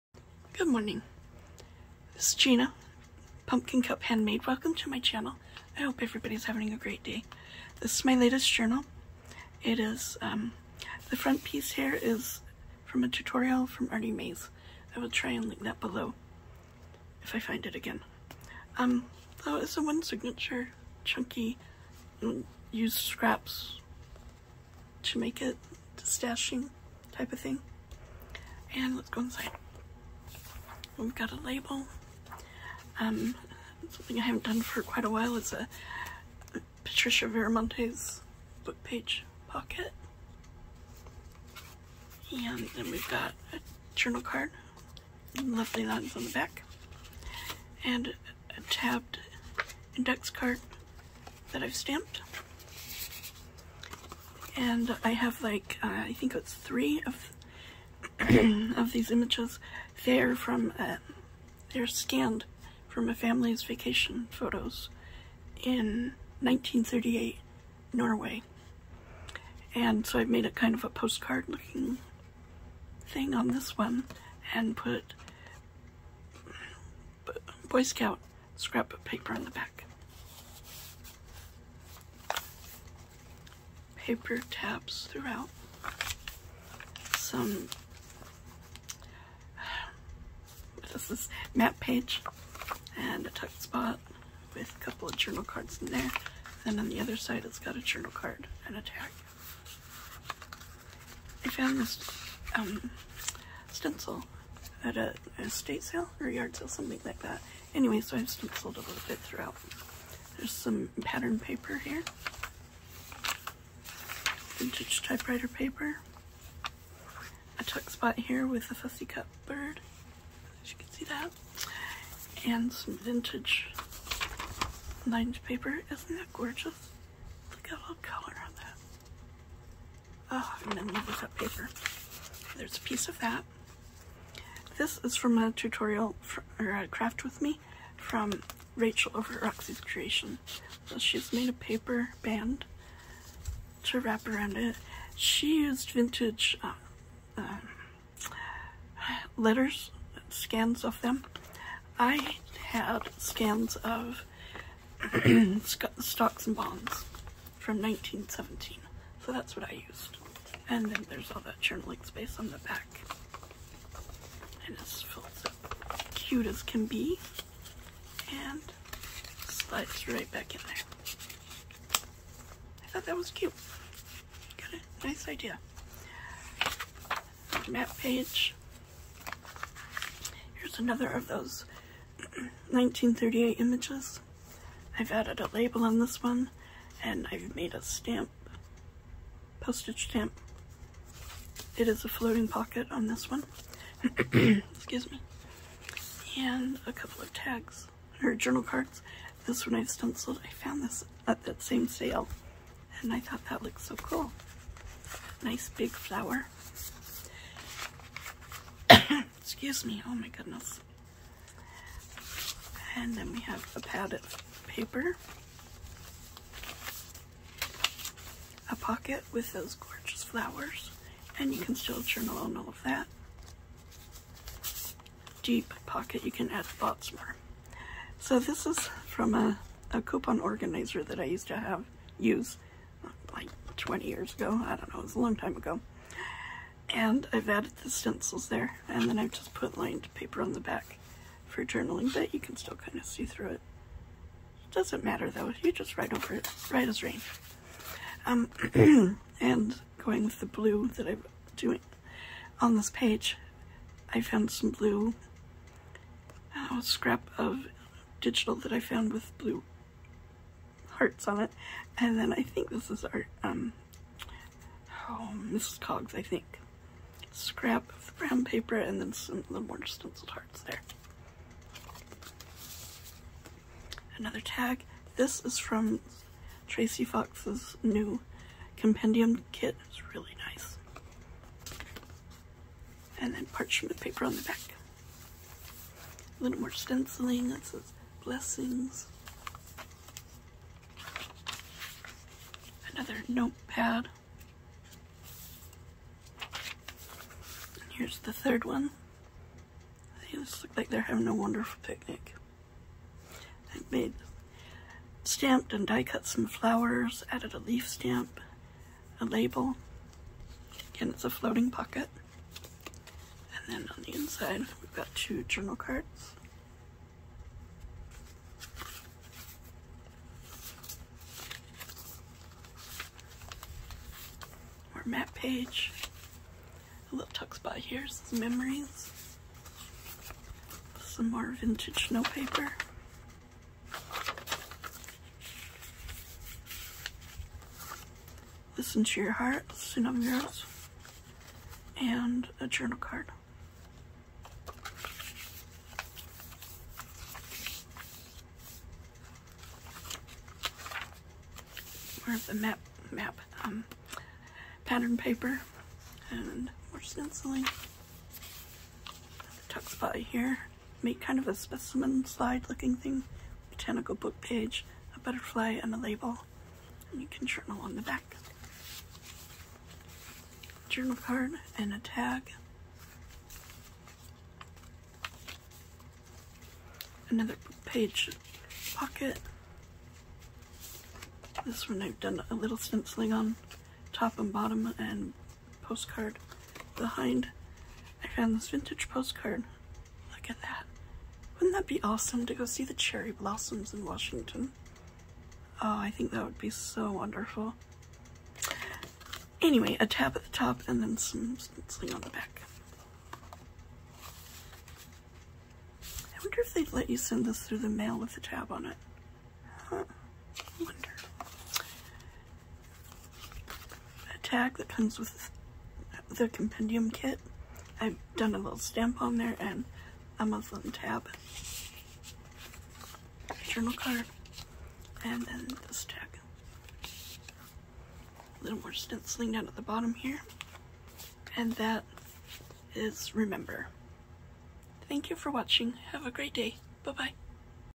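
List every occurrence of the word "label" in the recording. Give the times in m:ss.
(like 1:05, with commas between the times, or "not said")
0:31, 3:05, 5:09, 6:05.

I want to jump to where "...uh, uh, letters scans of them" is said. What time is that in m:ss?
2:26.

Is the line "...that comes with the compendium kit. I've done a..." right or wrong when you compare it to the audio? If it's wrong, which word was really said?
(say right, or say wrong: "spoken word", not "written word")
right.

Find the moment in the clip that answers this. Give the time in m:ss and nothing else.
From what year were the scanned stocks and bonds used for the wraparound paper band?
2:37.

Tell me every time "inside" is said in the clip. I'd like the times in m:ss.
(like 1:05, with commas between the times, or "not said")
0:29, 5:14.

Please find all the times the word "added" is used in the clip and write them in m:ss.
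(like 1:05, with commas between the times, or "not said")
3:05, 3:57, 5:07.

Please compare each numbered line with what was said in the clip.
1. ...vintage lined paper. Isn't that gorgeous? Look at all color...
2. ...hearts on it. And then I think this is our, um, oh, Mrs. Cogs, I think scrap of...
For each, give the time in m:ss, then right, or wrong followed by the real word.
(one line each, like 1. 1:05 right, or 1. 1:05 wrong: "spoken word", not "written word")
1. 2:02 right
2. 4:20 right.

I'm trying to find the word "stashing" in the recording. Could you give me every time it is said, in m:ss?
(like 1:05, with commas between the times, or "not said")
0:25.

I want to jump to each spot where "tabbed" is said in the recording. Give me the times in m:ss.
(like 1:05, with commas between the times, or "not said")
0:48.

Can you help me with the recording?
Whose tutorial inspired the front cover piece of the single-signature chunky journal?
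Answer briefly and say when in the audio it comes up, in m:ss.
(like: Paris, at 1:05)
Artie Mays, at 0:13.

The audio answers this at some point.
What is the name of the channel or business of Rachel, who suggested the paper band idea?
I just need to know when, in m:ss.
2:19.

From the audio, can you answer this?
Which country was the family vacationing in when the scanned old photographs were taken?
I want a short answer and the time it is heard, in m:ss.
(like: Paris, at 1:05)
Norway, at 1:07.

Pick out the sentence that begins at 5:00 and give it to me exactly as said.
These look like they're having a wonderful picnic.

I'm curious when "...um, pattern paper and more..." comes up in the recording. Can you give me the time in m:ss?
5:53.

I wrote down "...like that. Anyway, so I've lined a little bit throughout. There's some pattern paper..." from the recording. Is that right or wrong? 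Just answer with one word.
wrong.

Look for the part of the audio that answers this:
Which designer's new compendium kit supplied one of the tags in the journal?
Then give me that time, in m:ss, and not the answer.
4:36.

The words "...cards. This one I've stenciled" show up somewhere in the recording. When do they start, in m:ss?
3:18.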